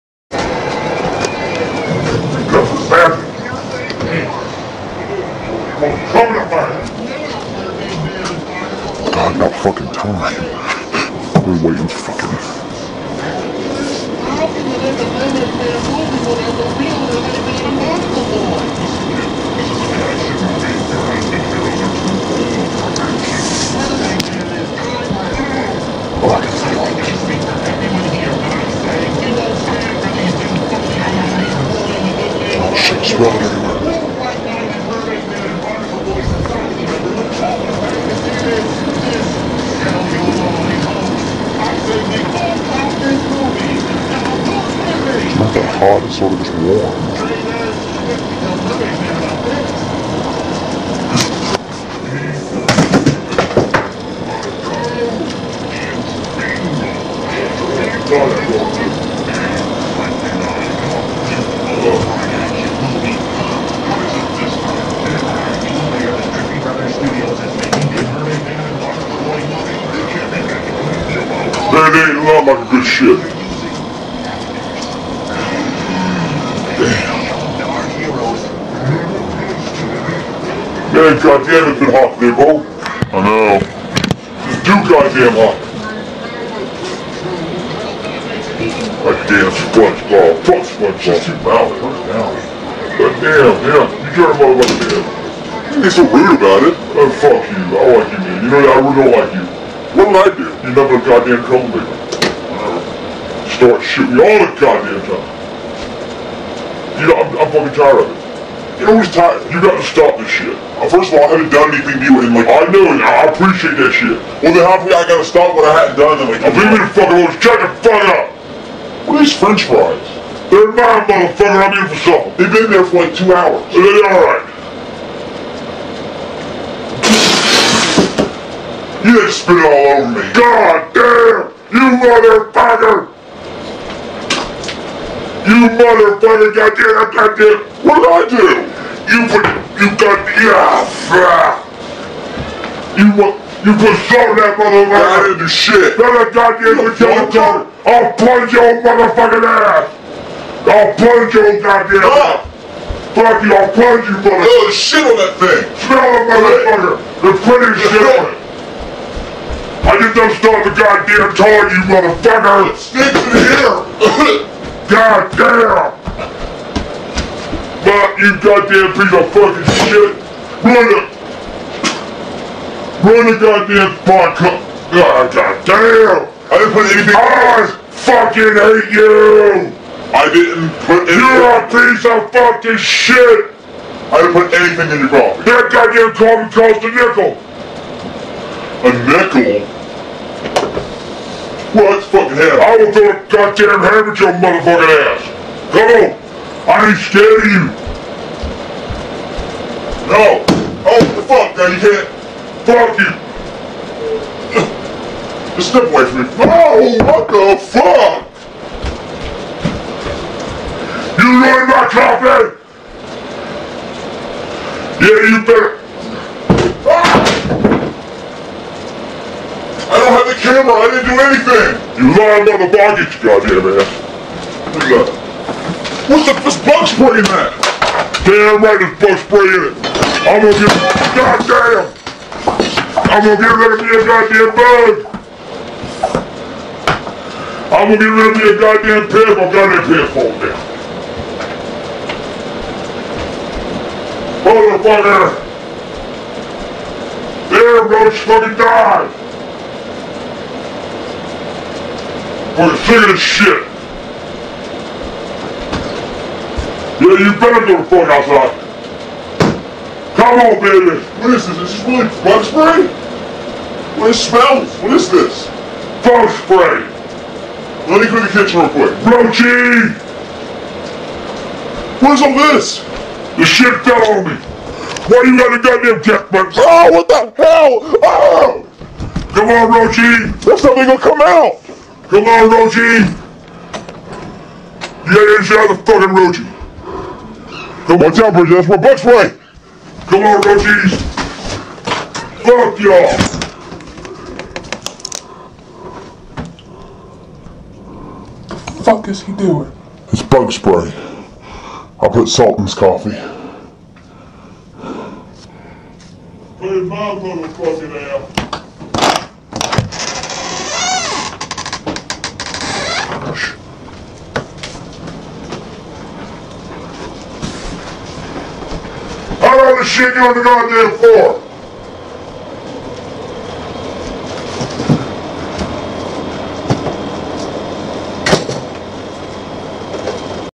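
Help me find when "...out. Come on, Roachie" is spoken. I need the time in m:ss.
4:41.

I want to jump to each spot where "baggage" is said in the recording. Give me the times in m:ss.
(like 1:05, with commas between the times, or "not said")
3:42.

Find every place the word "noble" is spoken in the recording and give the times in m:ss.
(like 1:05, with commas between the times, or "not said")
not said.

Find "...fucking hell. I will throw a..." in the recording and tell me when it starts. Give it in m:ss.
3:12.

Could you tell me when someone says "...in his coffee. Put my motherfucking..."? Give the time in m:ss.
5:02.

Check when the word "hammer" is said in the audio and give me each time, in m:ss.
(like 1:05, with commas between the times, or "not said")
3:13.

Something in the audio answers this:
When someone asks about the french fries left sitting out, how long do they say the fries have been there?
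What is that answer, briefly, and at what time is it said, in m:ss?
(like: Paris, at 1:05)
2 hours, at 2:03.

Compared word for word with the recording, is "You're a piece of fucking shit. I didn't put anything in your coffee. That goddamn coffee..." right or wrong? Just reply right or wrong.
right.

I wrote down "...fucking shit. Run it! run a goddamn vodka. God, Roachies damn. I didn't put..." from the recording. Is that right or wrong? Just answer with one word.
wrong.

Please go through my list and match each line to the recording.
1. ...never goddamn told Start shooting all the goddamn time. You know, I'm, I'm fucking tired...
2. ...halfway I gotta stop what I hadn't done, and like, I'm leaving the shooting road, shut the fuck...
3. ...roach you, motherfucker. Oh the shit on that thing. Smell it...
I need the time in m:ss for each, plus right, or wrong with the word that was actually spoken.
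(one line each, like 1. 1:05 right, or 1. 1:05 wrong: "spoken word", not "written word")
1. 1:40 right
2. 1:54 wrong: "fucking", not "shooting"
3. 2:33 wrong: "punch", not "roach".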